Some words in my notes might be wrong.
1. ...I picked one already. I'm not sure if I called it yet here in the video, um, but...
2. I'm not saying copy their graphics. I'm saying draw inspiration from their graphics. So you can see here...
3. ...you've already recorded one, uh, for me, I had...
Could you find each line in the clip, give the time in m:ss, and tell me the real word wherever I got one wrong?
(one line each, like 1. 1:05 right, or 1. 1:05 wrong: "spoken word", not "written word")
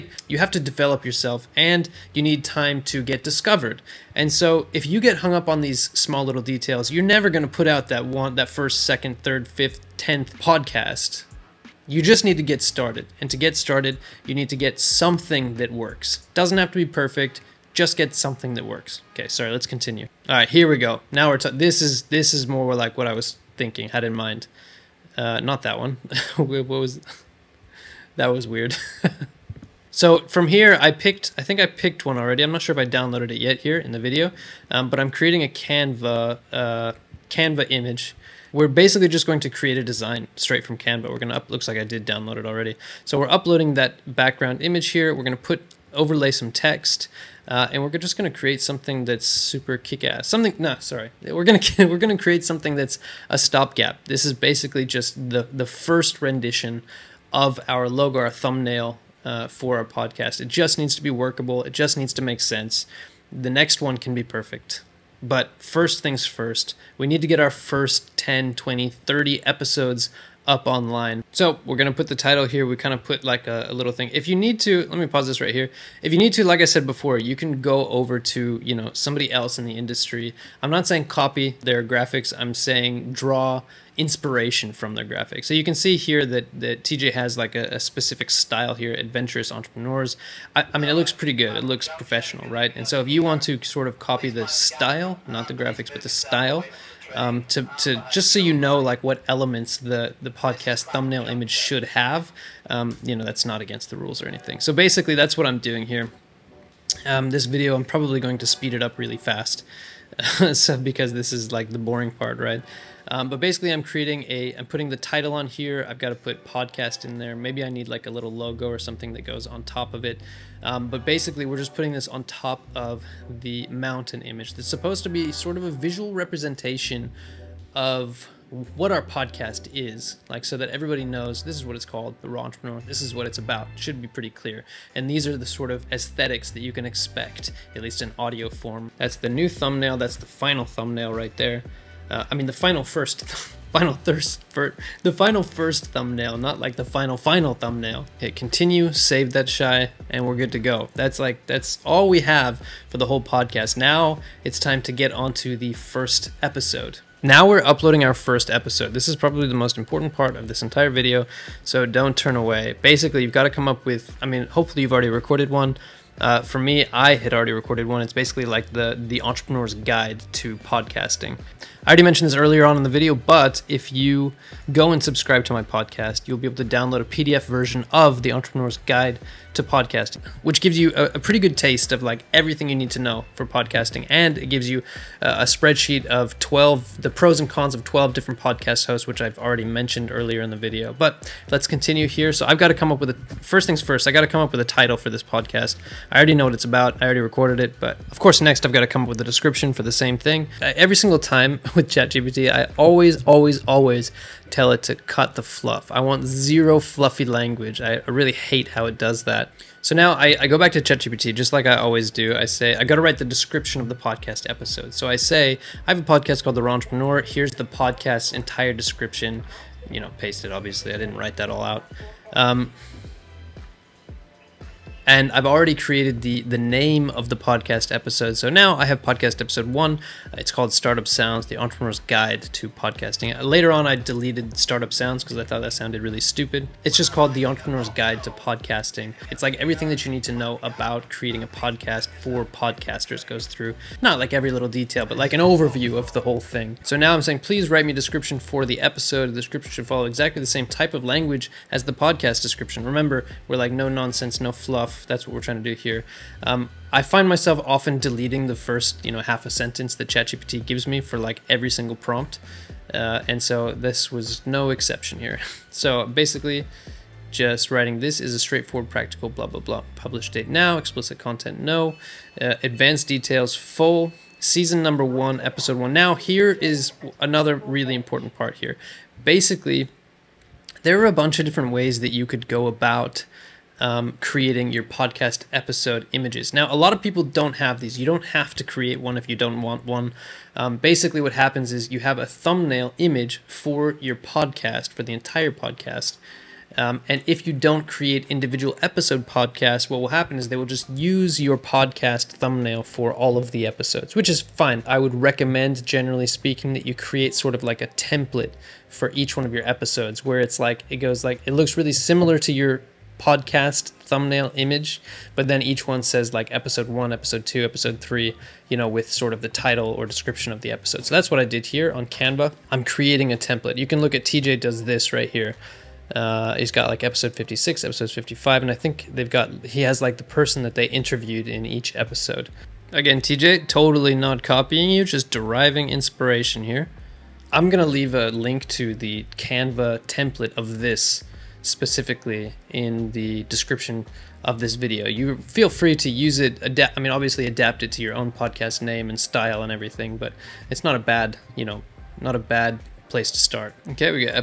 1. 0:31 wrong: "downloaded", not "called"
2. 1:20 right
3. 2:44 right.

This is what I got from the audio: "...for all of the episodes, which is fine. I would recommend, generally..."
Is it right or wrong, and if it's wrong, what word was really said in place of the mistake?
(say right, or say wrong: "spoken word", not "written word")
right.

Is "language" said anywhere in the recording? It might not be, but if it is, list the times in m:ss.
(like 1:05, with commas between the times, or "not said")
3:27, 4:11.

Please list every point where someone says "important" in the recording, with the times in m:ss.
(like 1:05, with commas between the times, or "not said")
2:39, 4:37.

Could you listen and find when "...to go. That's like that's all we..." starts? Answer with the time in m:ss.
2:30.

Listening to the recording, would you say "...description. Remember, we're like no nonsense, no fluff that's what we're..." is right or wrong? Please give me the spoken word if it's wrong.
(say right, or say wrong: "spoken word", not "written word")
right.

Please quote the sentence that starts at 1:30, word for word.
I, I mean, it looks pretty good.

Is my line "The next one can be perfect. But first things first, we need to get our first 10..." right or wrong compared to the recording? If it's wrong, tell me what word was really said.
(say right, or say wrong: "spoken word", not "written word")
right.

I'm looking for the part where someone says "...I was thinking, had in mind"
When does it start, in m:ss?
0:23.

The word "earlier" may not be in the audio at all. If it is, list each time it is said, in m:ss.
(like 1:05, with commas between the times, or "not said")
2:52, 3:10.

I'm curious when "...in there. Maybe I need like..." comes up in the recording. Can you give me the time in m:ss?
1:57.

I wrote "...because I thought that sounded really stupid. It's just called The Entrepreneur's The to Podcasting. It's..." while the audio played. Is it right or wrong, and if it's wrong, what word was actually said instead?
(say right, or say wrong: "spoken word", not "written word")
wrong: "Guide", not "The".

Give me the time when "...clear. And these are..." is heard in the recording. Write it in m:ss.
2:14.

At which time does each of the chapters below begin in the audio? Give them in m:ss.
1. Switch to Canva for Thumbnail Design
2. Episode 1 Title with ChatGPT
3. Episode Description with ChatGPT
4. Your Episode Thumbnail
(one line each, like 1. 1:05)
1. 0:28
2. 2:33
3. 3:23
4. 4:36.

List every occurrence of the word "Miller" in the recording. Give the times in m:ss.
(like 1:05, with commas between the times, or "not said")
not said.